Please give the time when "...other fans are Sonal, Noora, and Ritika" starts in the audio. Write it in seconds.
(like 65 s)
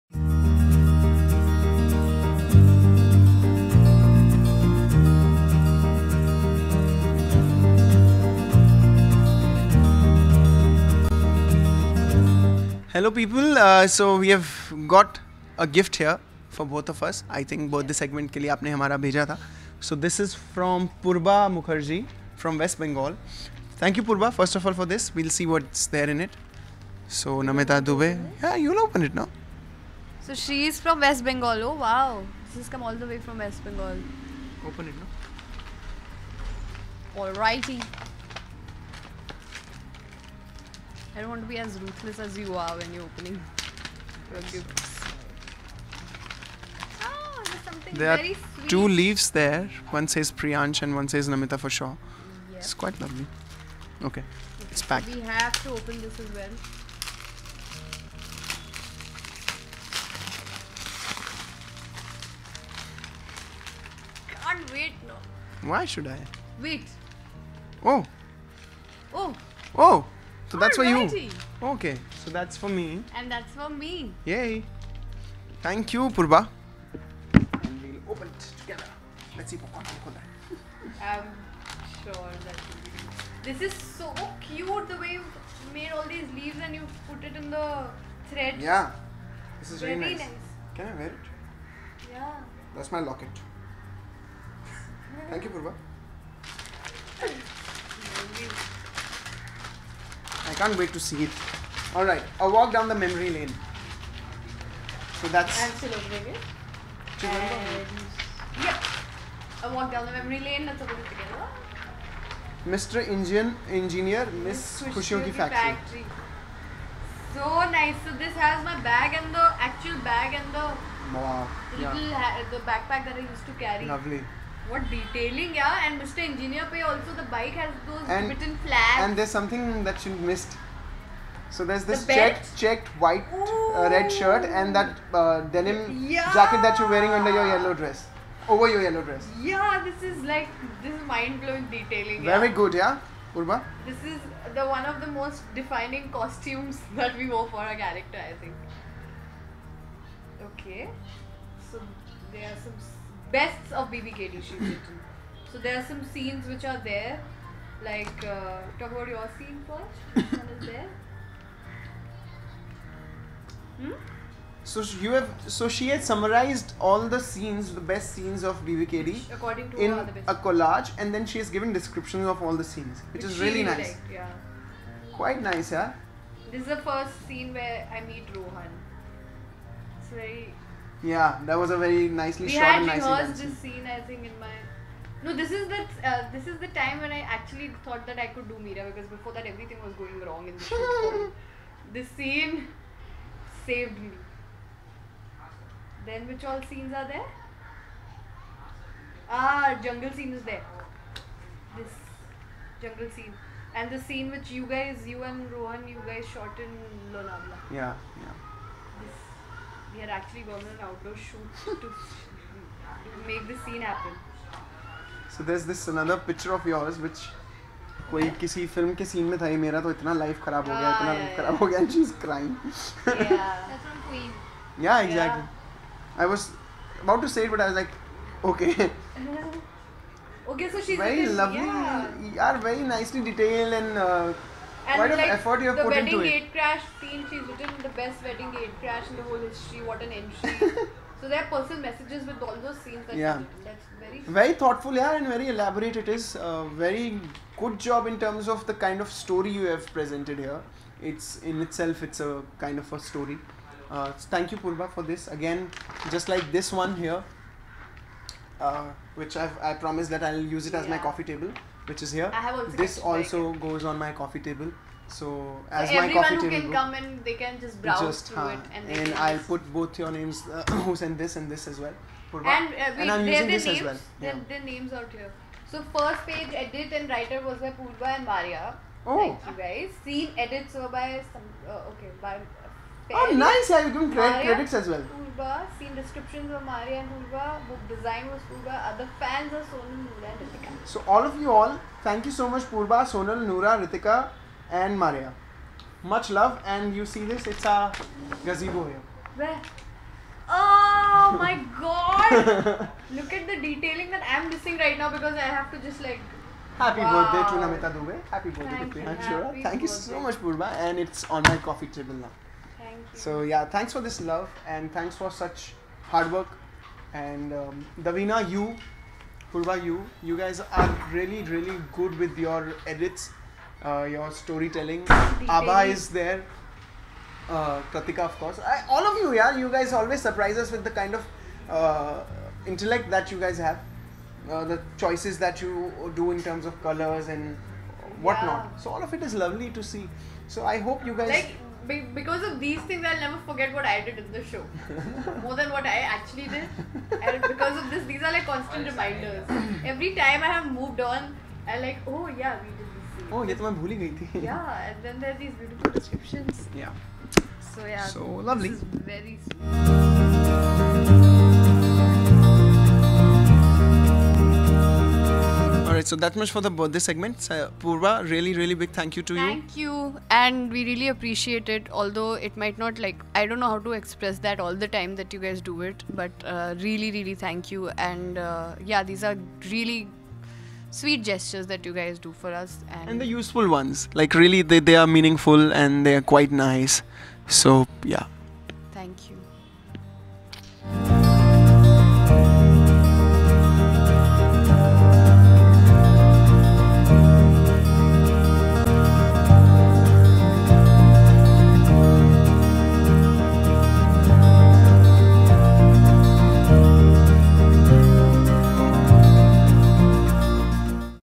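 288 s.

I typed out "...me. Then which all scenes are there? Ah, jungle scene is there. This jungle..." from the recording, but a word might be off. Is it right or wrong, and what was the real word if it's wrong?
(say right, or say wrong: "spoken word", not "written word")
right.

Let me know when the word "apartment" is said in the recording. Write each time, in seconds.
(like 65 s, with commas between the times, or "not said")
not said.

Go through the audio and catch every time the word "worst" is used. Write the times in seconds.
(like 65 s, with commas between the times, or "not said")
not said.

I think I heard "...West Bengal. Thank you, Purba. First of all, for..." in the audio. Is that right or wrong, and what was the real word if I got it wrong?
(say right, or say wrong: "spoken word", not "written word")
right.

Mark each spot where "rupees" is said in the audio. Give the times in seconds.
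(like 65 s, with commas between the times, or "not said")
not said.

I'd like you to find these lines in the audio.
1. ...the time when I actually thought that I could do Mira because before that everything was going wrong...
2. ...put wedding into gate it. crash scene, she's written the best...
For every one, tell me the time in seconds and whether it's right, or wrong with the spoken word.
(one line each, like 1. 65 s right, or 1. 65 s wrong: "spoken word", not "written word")
1. 186 s right
2. 235 s right.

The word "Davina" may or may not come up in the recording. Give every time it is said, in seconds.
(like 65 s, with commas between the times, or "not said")
318 s.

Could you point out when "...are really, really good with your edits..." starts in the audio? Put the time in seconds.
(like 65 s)
320 s.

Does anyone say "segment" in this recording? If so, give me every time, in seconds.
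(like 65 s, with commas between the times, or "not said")
17 s, 366 s.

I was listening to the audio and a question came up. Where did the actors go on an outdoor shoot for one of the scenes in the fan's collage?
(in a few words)
Lonavla.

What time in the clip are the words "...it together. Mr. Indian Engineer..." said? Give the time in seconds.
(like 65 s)
110 s.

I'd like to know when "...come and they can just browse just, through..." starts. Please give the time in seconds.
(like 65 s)
266 s.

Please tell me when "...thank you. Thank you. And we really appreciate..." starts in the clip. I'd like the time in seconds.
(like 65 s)
369 s.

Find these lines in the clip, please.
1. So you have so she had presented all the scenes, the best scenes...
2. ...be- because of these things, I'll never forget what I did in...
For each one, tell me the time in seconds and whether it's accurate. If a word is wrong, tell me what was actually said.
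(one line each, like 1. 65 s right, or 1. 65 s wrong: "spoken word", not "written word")
1. 164 s wrong: "summarized", not "presented"
2. 341 s right.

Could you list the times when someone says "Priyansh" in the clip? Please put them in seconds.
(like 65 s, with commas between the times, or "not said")
50 s, 308 s.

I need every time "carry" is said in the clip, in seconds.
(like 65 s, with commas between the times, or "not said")
123 s.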